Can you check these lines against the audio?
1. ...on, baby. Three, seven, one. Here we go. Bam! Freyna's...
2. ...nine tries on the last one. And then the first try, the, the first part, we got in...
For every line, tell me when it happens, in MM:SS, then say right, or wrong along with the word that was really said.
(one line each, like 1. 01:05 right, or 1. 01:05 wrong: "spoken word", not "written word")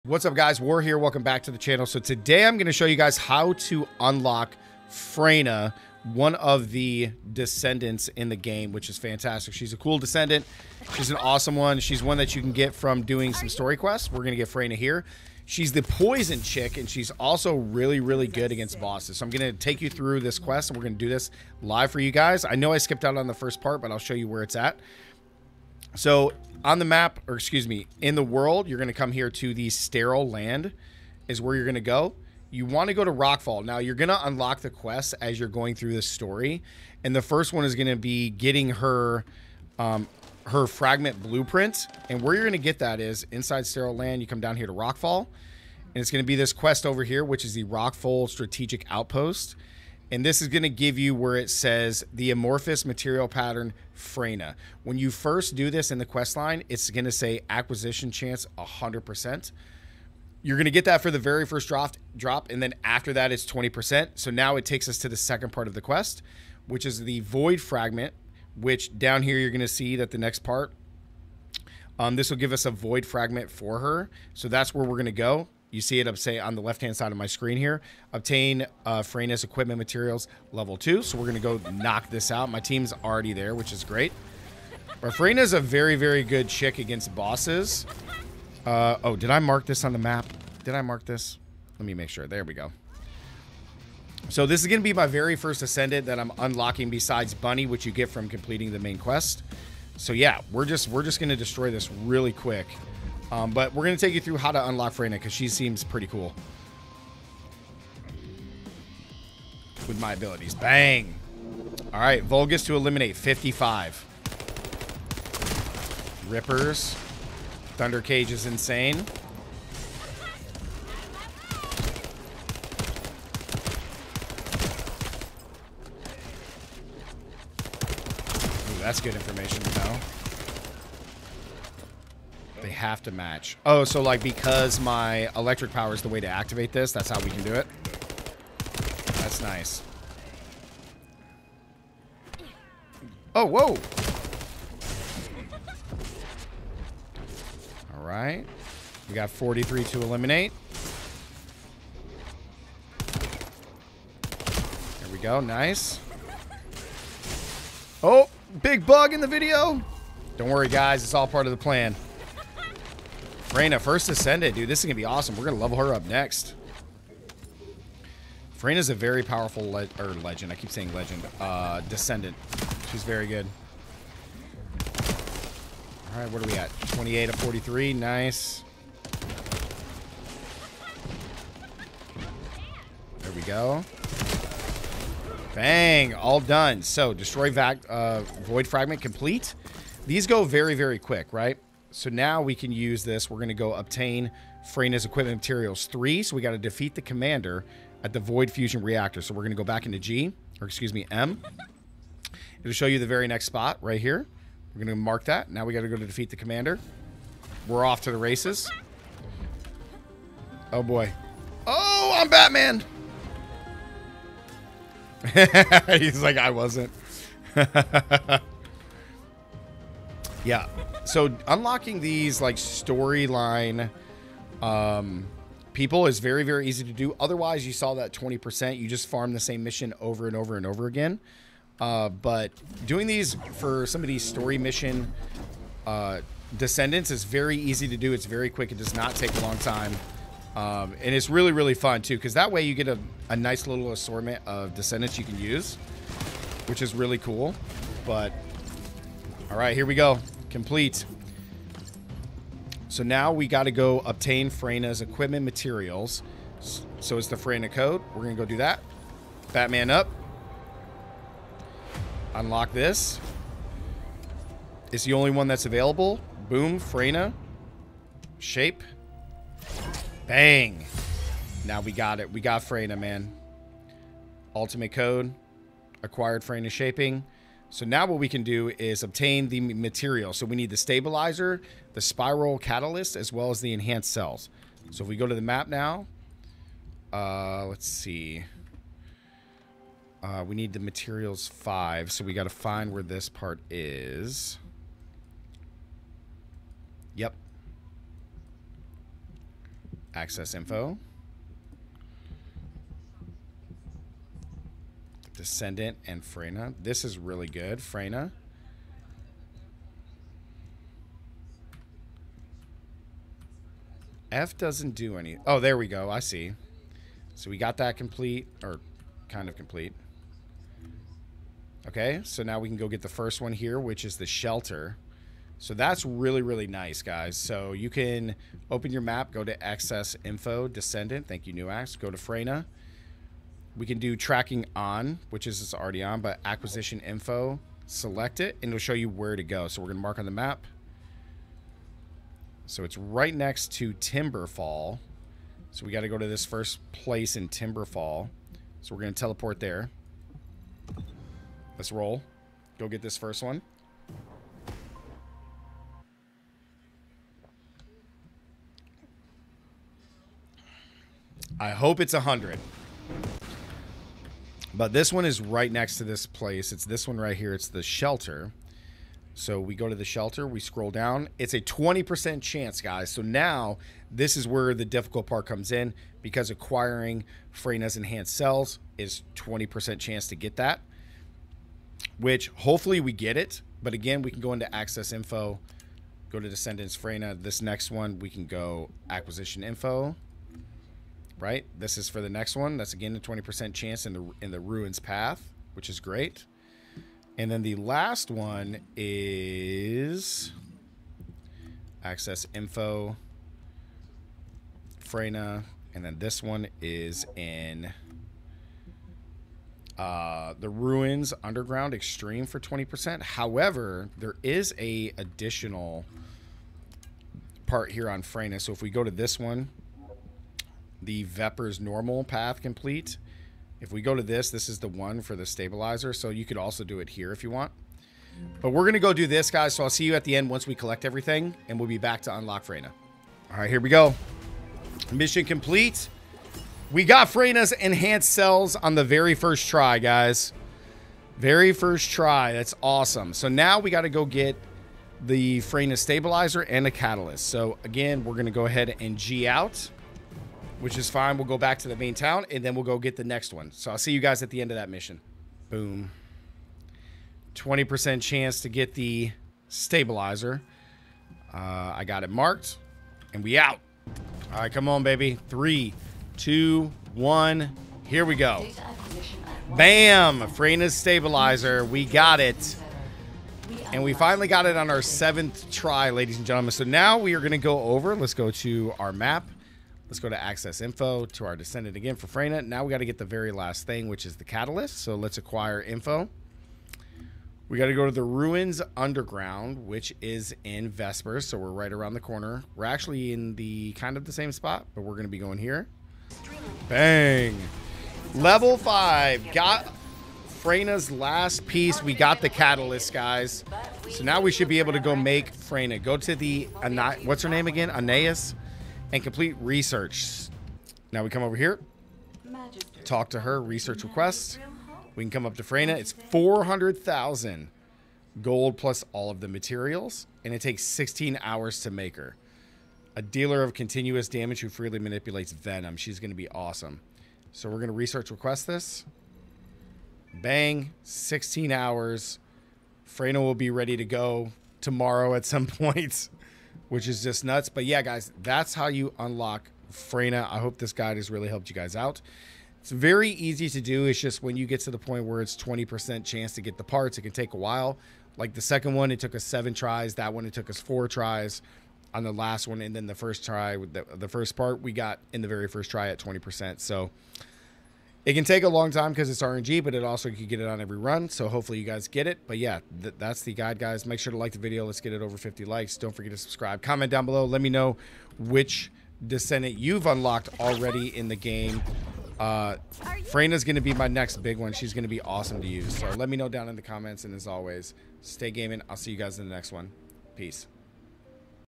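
1. 07:44 wrong: "two", not "seven"
2. 09:10 wrong: "four", not "nine".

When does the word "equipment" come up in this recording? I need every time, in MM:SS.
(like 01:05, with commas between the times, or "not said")
01:19, 03:15, 04:15.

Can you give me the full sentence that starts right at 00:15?
She's the poison chick and she's also really, really good against bosses.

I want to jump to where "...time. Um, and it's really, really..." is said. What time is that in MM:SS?
03:59.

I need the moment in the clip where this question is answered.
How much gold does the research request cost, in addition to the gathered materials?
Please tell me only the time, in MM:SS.
08:36.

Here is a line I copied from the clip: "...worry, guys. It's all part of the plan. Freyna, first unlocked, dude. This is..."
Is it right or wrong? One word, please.
wrong.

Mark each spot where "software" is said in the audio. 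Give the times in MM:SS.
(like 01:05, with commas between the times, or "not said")
not said.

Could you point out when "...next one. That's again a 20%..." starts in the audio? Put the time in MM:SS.
06:32.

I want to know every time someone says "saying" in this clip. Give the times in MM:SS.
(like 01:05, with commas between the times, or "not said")
02:50.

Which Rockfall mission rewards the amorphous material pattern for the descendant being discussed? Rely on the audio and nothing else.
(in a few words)
Rockfall Strategic Outpost.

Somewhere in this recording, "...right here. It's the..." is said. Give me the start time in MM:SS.
06:07.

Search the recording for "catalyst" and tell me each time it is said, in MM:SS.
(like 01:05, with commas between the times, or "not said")
04:42, 07:26, 08:04, 08:22.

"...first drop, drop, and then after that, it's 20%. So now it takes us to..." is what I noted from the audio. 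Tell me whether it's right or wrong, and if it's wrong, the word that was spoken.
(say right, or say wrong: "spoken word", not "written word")
right.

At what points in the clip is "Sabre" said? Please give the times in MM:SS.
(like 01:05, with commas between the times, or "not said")
not said.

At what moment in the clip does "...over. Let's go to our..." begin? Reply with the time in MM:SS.
07:57.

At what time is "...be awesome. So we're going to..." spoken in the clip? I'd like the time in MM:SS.
08:46.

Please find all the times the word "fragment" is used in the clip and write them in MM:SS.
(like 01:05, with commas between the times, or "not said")
00:40, 01:07, 01:13, 03:08.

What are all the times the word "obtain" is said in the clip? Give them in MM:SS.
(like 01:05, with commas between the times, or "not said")
01:18, 03:13, 04:14, 04:39.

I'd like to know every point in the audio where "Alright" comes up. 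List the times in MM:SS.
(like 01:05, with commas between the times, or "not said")
01:51, 02:27.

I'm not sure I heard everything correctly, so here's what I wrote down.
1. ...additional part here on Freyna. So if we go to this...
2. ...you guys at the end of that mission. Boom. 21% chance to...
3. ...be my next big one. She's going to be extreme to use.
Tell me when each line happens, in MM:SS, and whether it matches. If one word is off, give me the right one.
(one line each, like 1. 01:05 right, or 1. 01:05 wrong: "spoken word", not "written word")
1. 06:55 right
2. 07:34 wrong: "20", not "21"
3. 09:33 wrong: "awesome", not "extreme".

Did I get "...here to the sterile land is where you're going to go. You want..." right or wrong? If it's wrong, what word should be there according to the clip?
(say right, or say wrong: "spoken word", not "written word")
right.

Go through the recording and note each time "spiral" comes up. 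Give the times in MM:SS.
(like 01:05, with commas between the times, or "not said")
04:42.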